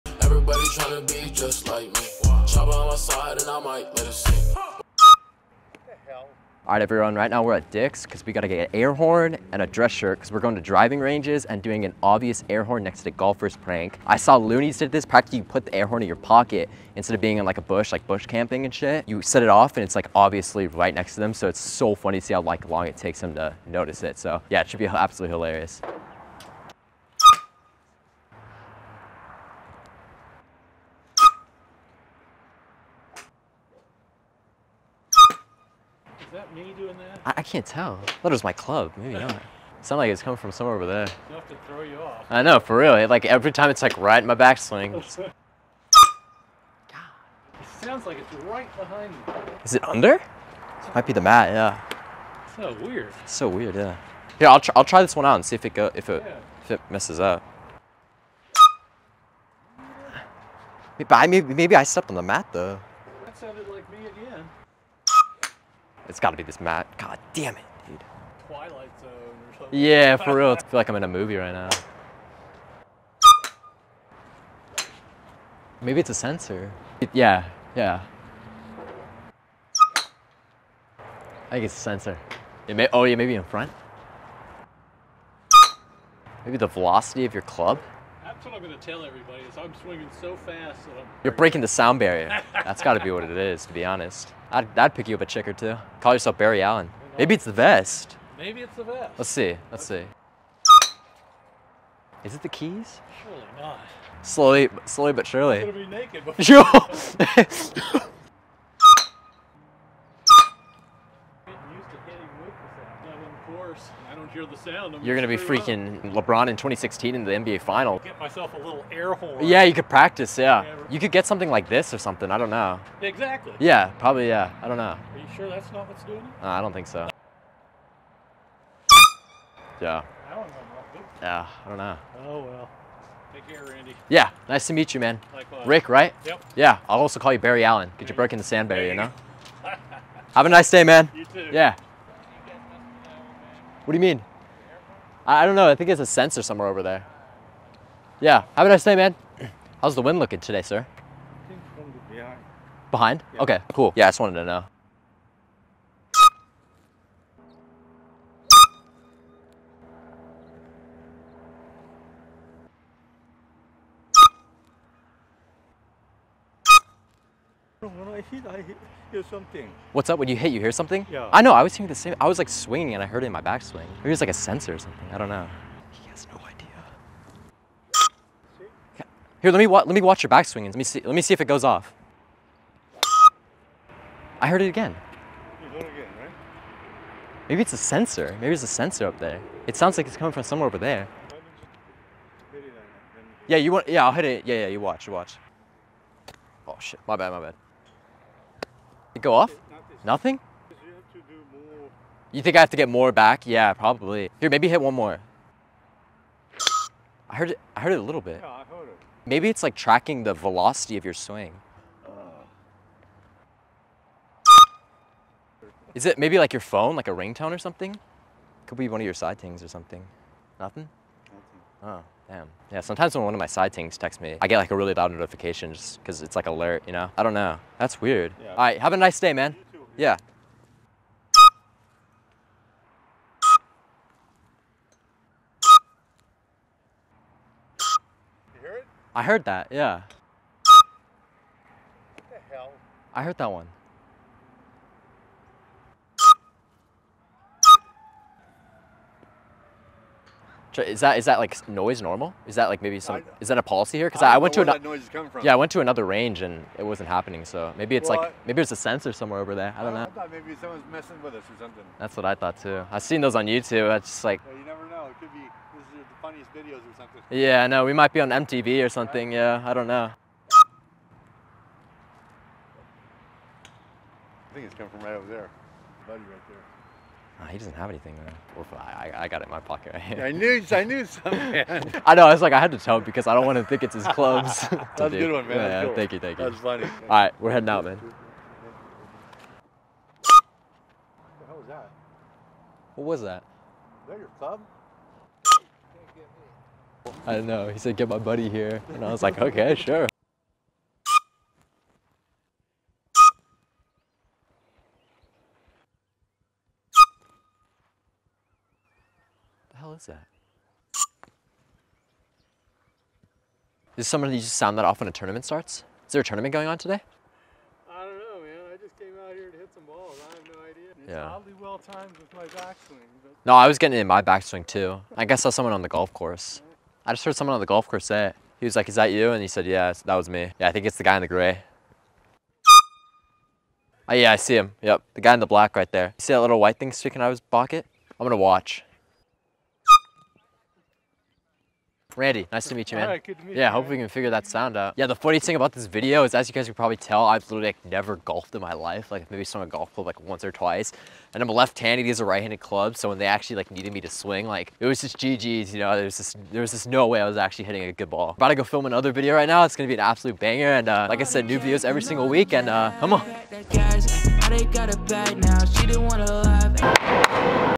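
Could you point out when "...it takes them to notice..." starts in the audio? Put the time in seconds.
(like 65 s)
22 s.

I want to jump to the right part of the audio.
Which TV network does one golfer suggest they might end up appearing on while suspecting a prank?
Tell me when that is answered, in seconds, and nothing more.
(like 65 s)
268 s.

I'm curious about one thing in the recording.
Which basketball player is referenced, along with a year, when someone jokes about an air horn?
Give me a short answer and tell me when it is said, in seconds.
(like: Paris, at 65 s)
LeBron, at 116 s.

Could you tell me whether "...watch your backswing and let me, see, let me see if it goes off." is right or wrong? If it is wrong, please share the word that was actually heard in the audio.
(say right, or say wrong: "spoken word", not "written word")
right.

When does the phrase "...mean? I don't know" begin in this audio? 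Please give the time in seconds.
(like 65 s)
144 s.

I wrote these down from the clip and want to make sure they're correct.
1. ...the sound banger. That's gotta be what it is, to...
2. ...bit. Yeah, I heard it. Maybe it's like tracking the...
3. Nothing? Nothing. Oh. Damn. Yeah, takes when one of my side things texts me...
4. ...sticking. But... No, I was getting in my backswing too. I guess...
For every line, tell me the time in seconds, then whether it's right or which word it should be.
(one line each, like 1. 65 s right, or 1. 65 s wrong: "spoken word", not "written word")
1. 91 s wrong: "barrier", not "banger"
2. 208 s right
3. 220 s wrong: "sometimes", not "takes"
4. 322 s wrong: "backswing", not "sticking".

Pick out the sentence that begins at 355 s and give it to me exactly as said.
You know, there's just there was just no way I was actually hitting a good ball.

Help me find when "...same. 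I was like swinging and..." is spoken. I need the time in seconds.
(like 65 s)
171 s.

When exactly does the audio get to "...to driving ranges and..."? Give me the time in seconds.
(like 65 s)
10 s.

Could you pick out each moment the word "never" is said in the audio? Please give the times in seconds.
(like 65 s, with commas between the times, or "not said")
264 s, 347 s.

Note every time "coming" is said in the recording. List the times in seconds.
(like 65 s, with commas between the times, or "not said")
40 s, 190 s, 255 s, 274 s.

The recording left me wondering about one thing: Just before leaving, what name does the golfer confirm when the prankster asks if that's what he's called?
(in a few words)
Rick.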